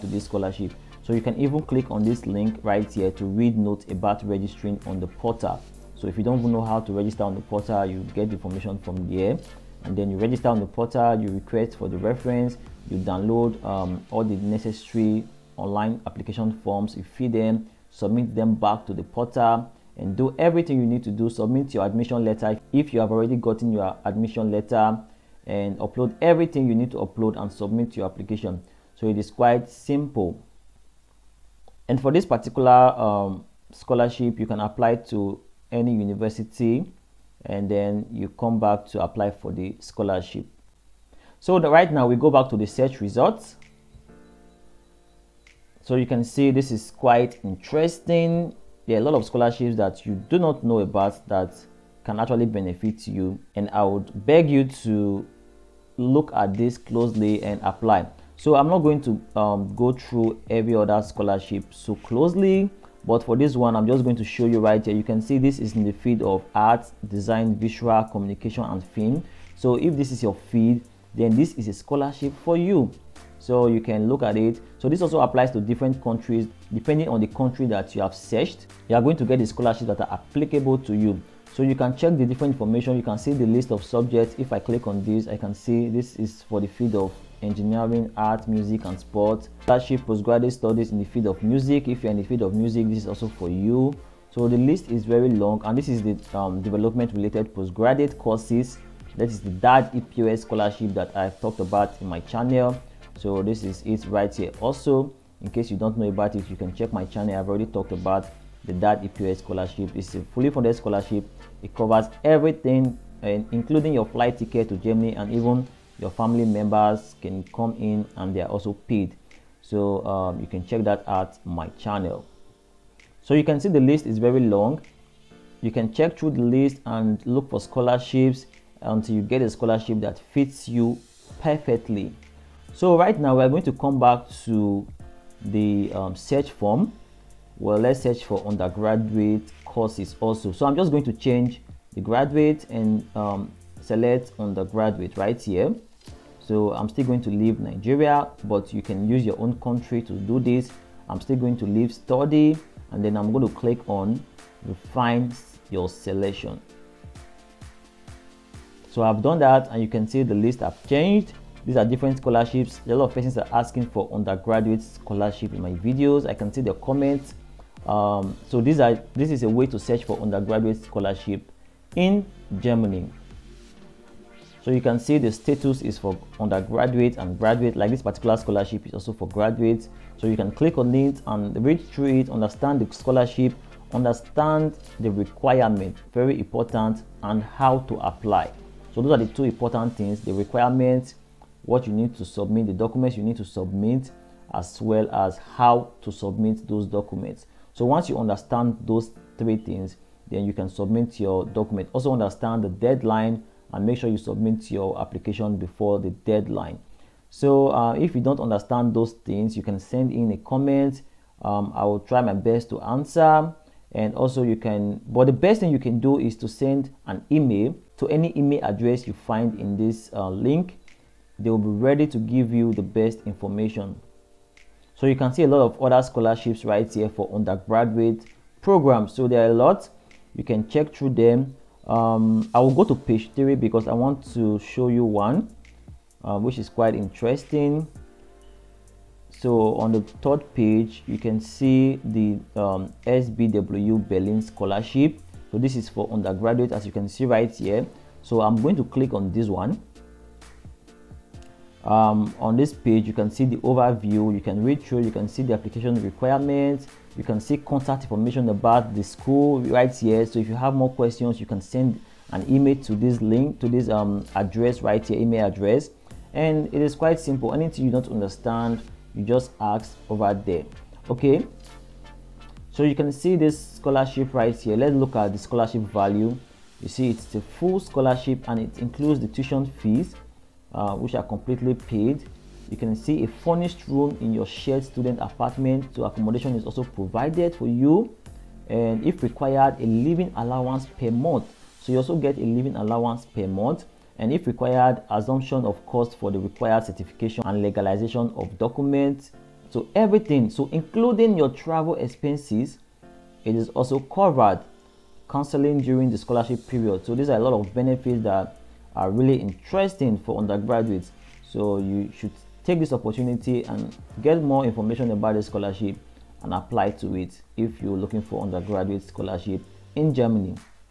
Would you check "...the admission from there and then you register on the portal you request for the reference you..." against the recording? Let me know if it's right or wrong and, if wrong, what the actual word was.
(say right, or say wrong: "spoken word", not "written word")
wrong: "information", not "admission".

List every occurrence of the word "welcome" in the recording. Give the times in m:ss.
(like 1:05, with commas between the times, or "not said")
not said.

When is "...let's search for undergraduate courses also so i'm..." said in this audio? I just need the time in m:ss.
2:17.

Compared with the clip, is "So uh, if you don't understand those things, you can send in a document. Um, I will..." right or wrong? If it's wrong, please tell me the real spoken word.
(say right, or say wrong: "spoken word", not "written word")
wrong: "comment", not "document".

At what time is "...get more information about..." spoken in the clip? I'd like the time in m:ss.
5:14.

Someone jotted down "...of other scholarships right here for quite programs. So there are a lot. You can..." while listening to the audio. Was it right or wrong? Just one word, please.
wrong.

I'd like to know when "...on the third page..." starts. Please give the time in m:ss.
3:59.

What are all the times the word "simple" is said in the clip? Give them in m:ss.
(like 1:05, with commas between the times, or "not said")
0:29, 4:27.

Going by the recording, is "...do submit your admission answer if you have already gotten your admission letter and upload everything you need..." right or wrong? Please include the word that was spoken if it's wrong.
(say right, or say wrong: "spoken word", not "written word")
wrong: "letter", not "answer".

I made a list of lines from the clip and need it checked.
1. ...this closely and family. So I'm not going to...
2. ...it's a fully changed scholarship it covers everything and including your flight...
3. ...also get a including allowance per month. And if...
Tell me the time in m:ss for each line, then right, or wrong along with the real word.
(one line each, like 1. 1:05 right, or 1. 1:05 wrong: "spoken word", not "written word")
1. 0:56 wrong: "apply", not "family"
2. 1:49 wrong: "funded", not "changed"
3. 4:51 wrong: "living", not "including".